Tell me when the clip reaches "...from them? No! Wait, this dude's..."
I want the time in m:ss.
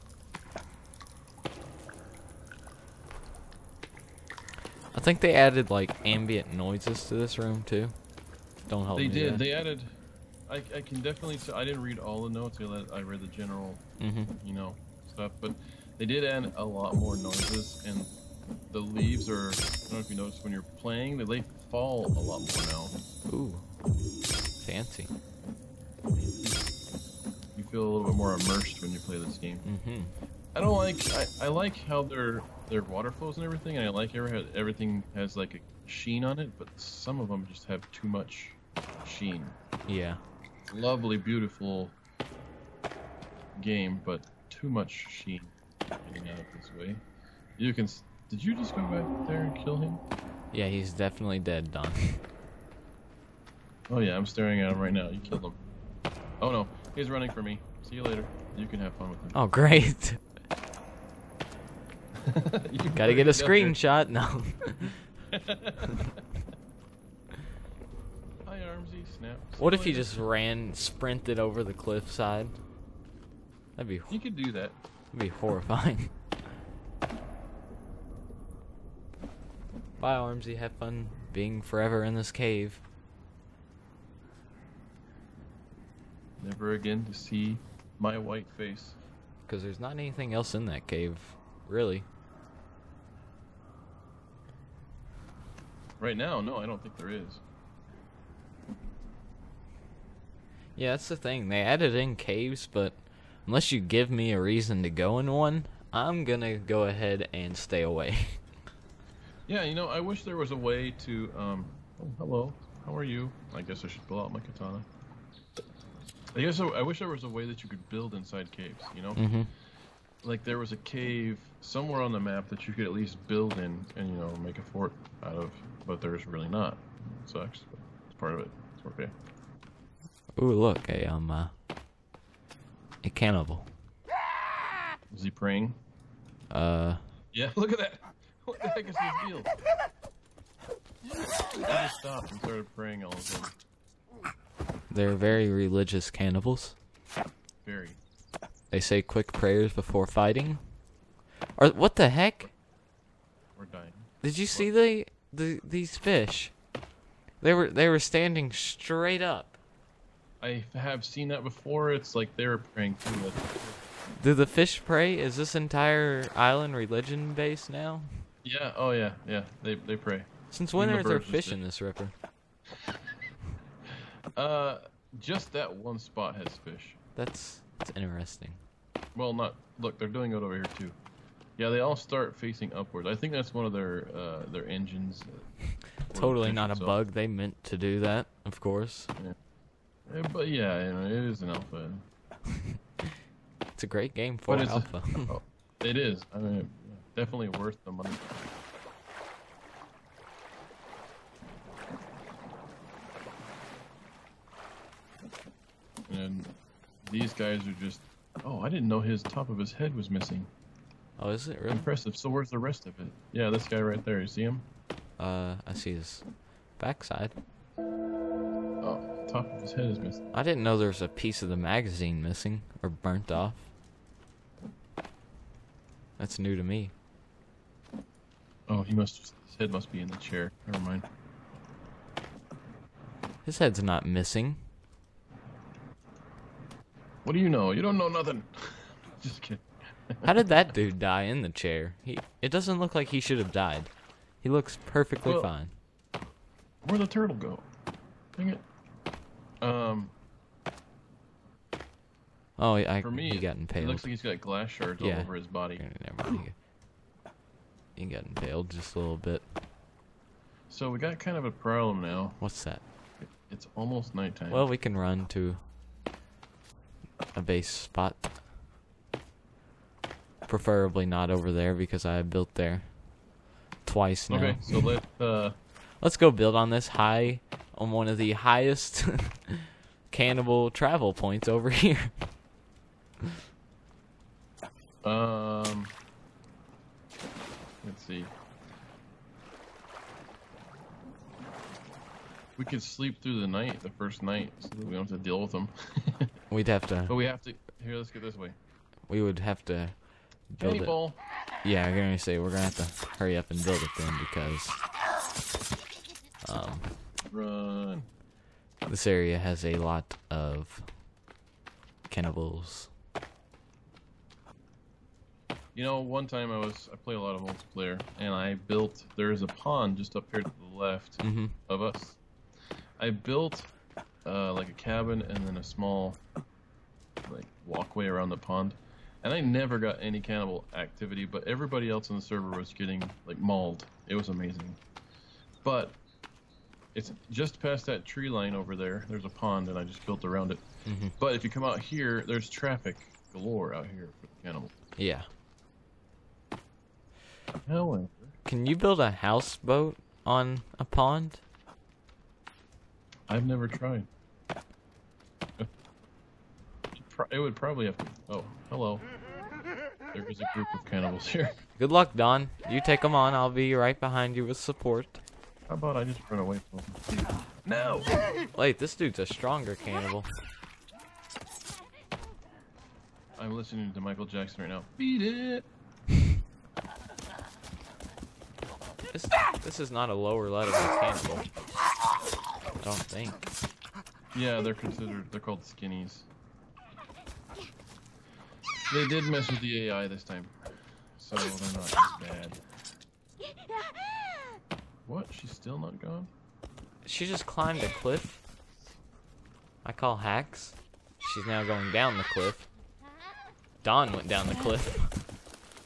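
6:06.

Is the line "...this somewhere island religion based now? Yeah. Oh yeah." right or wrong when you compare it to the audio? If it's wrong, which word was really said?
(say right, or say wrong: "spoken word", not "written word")
wrong: "entire", not "somewhere".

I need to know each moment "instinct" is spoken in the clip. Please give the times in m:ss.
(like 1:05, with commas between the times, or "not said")
not said.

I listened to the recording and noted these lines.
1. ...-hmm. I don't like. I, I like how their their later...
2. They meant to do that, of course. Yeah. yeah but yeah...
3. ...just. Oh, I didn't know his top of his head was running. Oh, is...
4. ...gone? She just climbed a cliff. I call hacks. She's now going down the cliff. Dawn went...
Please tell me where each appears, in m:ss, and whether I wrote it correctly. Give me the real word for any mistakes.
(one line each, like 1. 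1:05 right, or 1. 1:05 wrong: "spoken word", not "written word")
1. 0:29 wrong: "water", not "later"
2. 3:07 right
3. 3:27 wrong: "missing", not "running"
4. 6:35 right.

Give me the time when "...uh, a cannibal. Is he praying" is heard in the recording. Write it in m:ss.
2:11.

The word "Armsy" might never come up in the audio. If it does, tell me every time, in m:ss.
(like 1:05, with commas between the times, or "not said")
1:08, 1:20.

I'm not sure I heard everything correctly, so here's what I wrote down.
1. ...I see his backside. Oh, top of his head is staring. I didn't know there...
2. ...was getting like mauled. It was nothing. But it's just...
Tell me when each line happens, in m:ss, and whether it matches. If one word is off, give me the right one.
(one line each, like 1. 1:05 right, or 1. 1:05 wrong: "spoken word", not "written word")
1. 3:35 wrong: "missing", not "staring"
2. 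5:32 wrong: "amazing", not "nothing".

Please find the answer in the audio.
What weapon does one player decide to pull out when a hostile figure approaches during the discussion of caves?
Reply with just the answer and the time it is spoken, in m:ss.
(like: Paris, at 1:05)
Katana, at 1:54.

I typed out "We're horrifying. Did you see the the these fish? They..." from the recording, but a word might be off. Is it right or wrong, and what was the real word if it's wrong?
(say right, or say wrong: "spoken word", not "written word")
wrong: "dying", not "horrifying".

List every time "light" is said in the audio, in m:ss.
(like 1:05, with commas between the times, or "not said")
not said.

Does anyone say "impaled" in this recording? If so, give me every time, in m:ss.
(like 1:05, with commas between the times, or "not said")
4:13, 4:18.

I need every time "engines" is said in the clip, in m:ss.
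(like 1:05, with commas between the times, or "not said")
3:04.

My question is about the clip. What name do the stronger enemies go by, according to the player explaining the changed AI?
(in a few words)
Skinnies.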